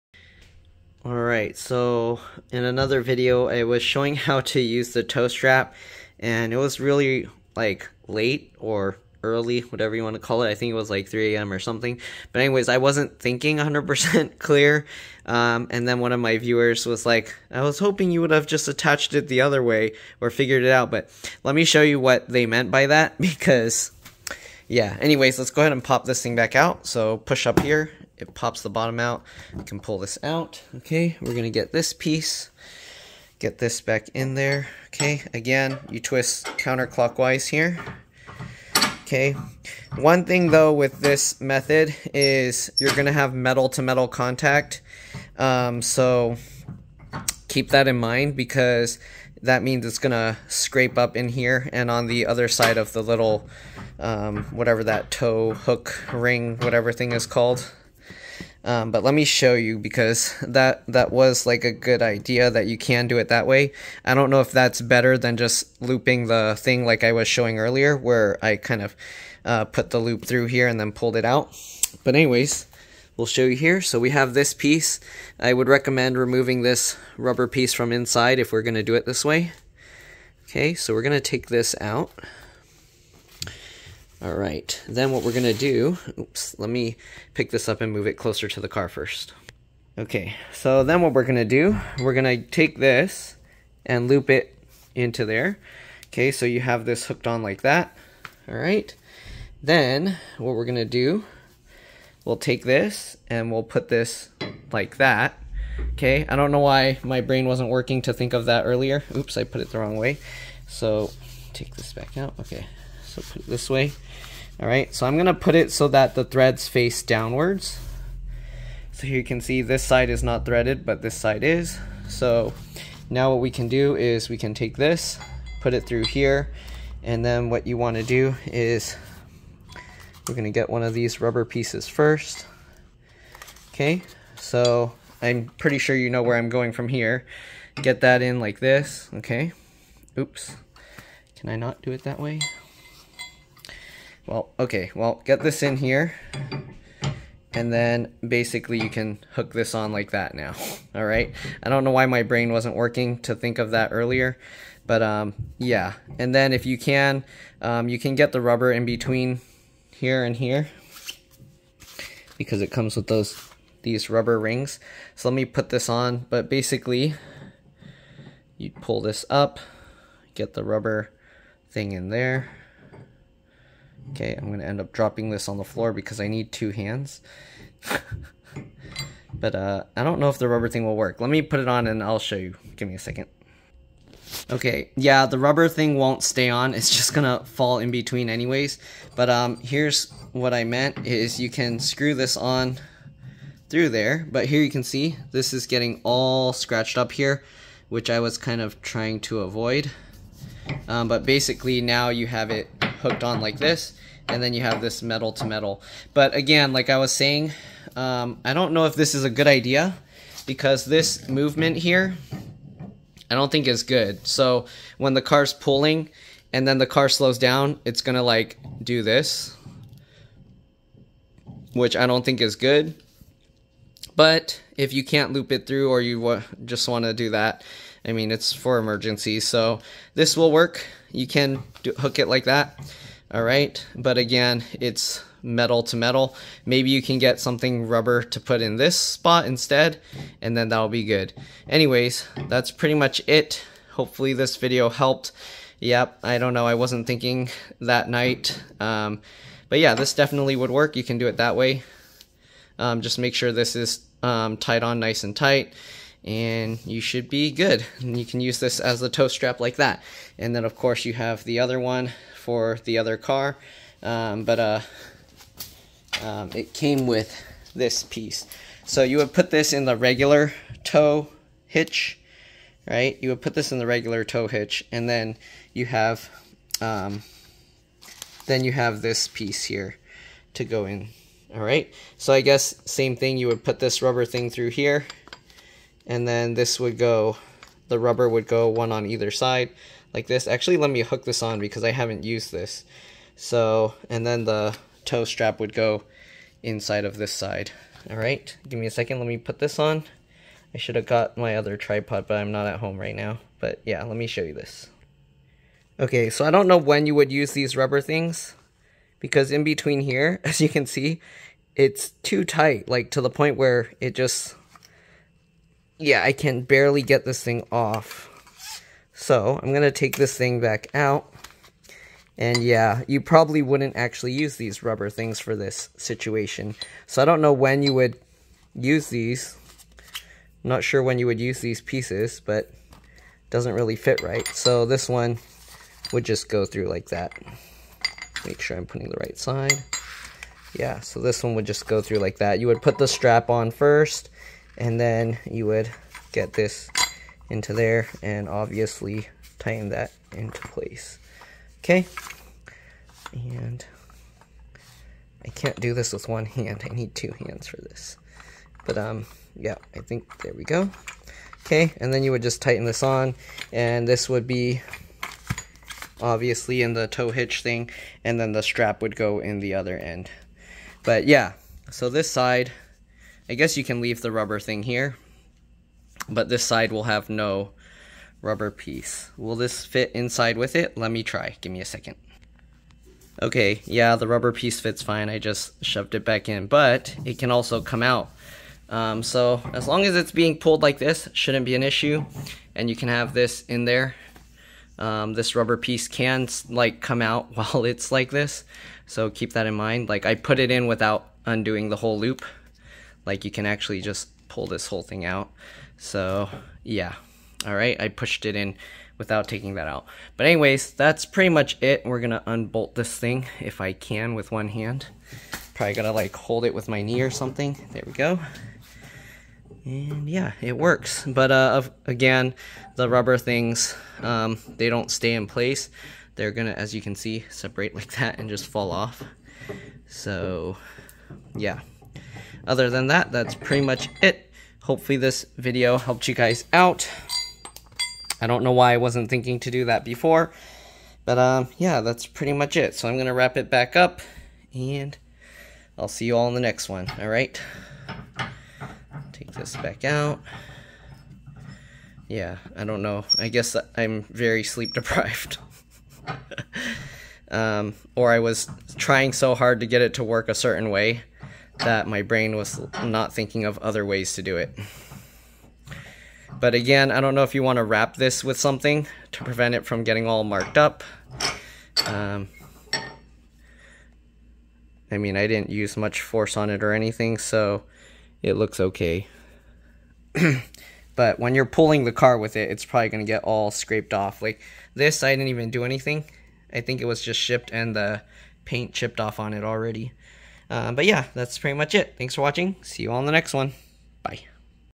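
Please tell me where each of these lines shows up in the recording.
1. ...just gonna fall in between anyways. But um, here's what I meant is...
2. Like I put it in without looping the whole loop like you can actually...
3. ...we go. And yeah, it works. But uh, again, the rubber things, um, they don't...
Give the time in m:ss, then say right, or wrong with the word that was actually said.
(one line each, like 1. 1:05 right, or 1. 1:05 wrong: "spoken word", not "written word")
1. 3:06 right
2. 6:40 wrong: "undoing", not "looping"
3. 6:58 right.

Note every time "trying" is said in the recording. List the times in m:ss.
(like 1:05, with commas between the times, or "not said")
3:18, 7:38.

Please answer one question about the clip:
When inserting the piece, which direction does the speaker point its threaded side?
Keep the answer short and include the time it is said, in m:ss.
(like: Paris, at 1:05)
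Downwards, at 1:56.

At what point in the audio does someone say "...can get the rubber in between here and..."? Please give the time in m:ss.
2:37.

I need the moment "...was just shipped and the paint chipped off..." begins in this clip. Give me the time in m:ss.
8:07.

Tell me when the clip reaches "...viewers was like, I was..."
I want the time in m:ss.
0:16.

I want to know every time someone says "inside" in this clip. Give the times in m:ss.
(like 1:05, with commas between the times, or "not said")
1:17, 4:56, 6:20.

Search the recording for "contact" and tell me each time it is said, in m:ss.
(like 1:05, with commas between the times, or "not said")
0:44.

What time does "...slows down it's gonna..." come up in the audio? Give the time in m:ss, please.
3:37.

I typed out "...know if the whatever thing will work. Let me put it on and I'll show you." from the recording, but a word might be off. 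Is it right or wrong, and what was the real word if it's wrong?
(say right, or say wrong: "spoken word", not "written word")
wrong: "rubber", not "whatever".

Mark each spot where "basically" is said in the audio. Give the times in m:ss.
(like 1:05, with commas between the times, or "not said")
2:28, 2:46, 3:21.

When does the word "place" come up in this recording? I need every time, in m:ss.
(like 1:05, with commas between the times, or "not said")
5:50, 7:05.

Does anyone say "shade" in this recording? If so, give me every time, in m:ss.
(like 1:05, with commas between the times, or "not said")
not said.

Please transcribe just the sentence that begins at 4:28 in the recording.
So you would put this in the regular tow hitch, right?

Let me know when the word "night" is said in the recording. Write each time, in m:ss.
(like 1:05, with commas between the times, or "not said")
4:08.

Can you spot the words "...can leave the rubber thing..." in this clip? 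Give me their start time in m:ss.
6:13.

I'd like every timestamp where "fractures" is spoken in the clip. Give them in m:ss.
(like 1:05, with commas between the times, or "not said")
not said.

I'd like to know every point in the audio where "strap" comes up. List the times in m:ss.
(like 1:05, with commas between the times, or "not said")
0:05, 4:19, 4:55, 5:43, 6:08.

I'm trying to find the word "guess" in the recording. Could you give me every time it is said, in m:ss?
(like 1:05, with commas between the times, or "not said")
4:42, 6:13, 7:33.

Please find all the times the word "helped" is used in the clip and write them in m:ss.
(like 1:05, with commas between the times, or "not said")
4:04, 7:15.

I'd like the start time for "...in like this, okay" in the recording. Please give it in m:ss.
2:18.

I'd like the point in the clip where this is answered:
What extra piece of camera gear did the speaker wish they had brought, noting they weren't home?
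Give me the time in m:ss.
5:01.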